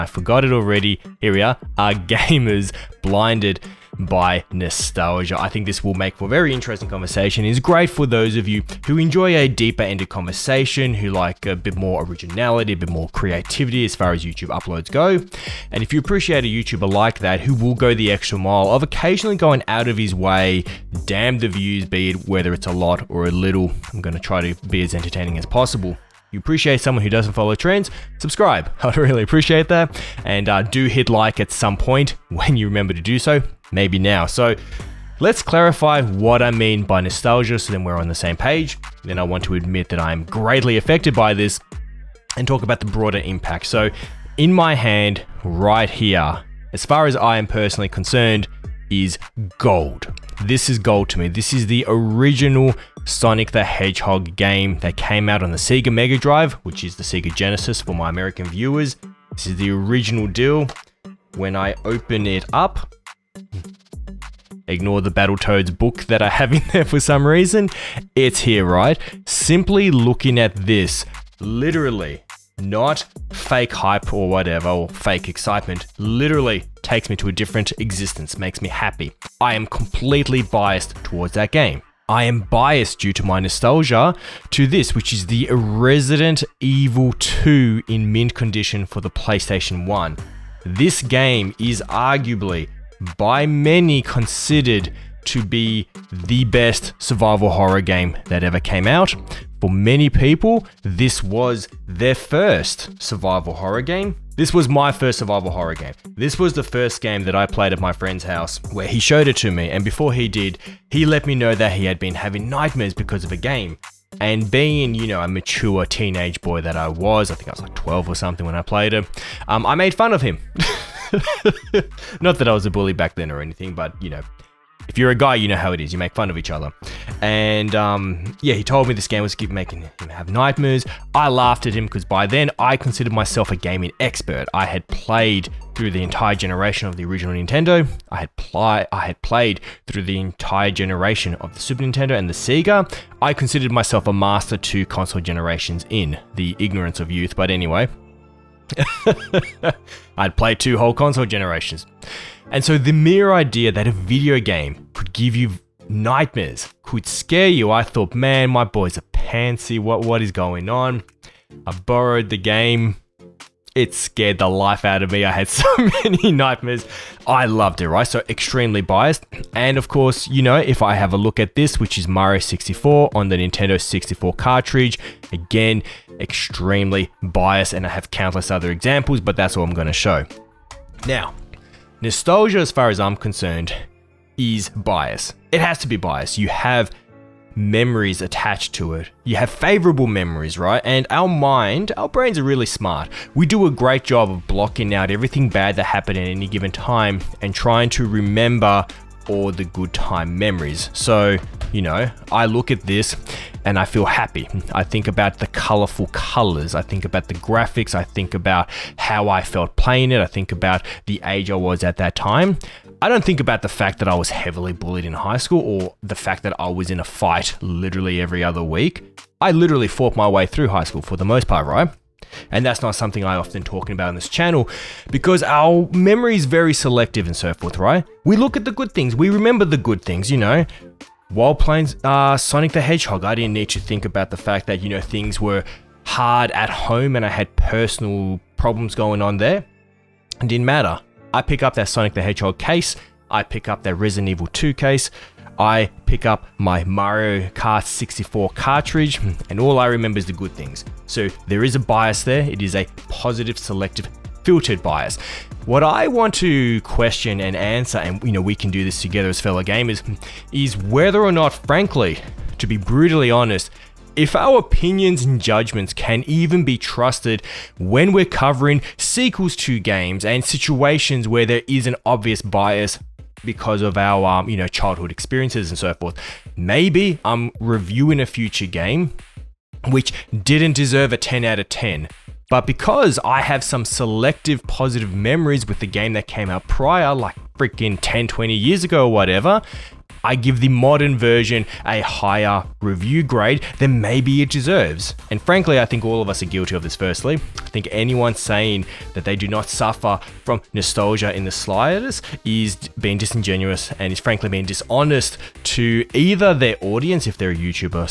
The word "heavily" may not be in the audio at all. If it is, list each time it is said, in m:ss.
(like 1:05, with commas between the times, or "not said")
3:34.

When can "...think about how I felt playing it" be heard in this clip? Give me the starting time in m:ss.
3:28.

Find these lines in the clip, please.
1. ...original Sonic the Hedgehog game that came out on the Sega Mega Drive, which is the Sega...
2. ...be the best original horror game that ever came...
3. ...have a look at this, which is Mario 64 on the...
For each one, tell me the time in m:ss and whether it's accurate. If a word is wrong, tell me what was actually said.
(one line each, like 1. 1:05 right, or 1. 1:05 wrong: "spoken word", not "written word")
1. 0:51 right
2. 1:35 wrong: "survival", not "original"
3. 2:50 right.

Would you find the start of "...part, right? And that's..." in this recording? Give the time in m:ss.
3:41.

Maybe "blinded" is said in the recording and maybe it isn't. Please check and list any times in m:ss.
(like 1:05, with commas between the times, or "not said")
0:03.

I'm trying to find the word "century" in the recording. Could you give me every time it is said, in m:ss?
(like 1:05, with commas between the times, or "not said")
not said.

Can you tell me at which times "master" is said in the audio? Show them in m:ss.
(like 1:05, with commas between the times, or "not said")
2:24.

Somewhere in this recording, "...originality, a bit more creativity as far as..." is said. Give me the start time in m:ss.
0:12.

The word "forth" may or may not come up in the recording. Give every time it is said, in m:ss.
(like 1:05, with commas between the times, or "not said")
3:47, 4:35.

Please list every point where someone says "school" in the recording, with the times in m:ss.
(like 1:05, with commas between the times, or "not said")
3:35, 3:40.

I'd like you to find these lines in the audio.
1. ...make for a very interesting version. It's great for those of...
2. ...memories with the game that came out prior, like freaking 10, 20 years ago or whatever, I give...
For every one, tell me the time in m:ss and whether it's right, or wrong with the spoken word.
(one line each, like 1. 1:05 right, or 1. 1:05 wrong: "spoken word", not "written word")
1. 0:05 wrong: "conversation", not "version"
2. 4:45 right.